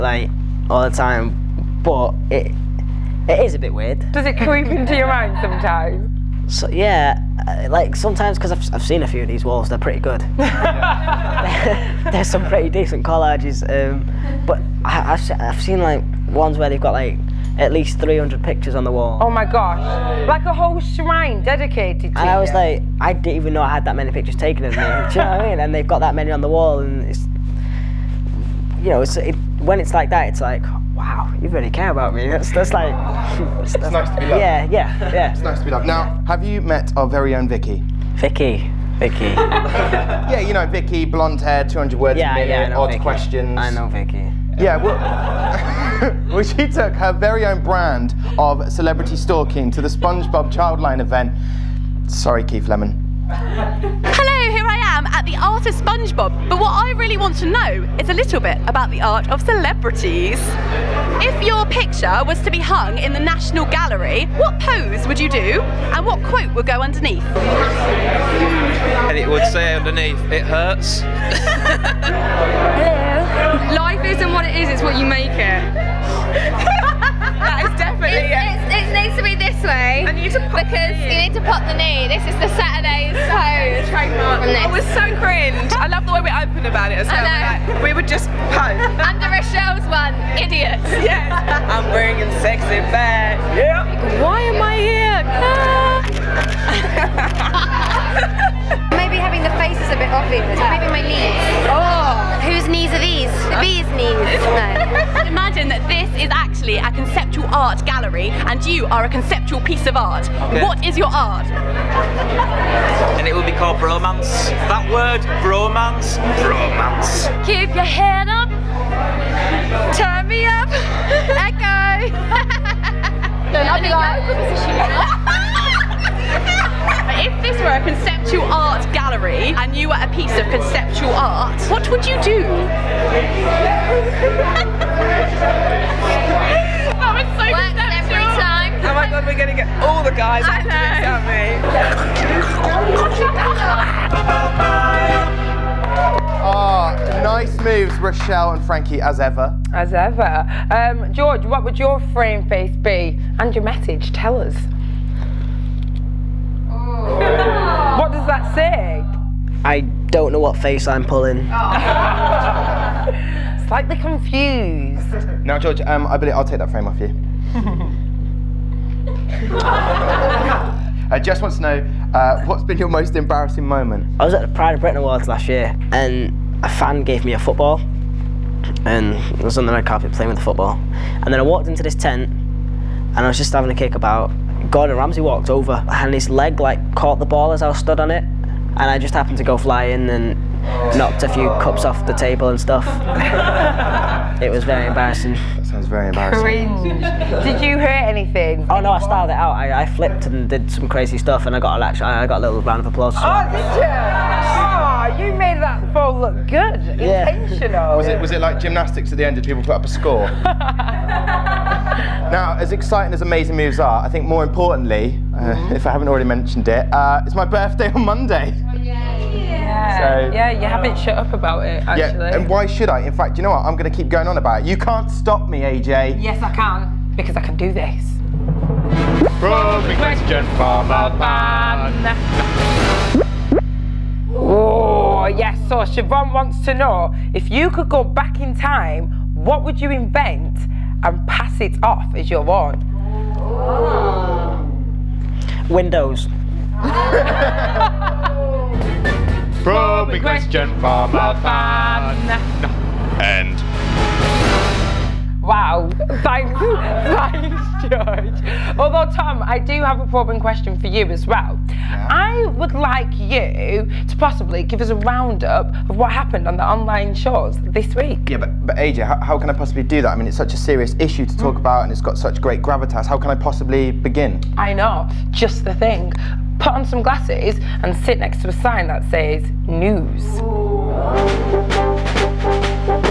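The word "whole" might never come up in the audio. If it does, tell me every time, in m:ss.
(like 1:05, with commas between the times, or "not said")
0:20.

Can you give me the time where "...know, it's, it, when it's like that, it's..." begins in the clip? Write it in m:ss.
0:28.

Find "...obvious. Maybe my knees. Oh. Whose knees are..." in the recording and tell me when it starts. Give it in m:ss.
1:40.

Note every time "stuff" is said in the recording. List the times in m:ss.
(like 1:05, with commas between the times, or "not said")
3:12, 3:21.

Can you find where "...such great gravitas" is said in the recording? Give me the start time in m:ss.
4:32.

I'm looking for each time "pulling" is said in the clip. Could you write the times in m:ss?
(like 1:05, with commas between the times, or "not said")
2:41.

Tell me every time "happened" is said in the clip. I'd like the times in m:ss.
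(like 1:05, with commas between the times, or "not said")
3:09, 4:26.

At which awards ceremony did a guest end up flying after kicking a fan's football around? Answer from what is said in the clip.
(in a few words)
Pride of Britain Awards.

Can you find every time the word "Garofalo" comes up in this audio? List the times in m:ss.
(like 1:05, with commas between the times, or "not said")
not said.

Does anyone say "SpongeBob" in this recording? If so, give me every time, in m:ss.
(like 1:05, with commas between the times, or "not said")
0:49, 0:55.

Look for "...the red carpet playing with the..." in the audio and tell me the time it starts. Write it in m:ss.
2:59.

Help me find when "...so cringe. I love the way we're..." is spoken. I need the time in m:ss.
1:24.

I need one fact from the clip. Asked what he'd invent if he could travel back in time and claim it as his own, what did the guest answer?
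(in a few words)
Windows.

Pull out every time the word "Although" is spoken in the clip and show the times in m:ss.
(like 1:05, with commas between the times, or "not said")
4:18.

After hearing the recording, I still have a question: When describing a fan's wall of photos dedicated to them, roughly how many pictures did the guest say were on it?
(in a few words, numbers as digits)
300.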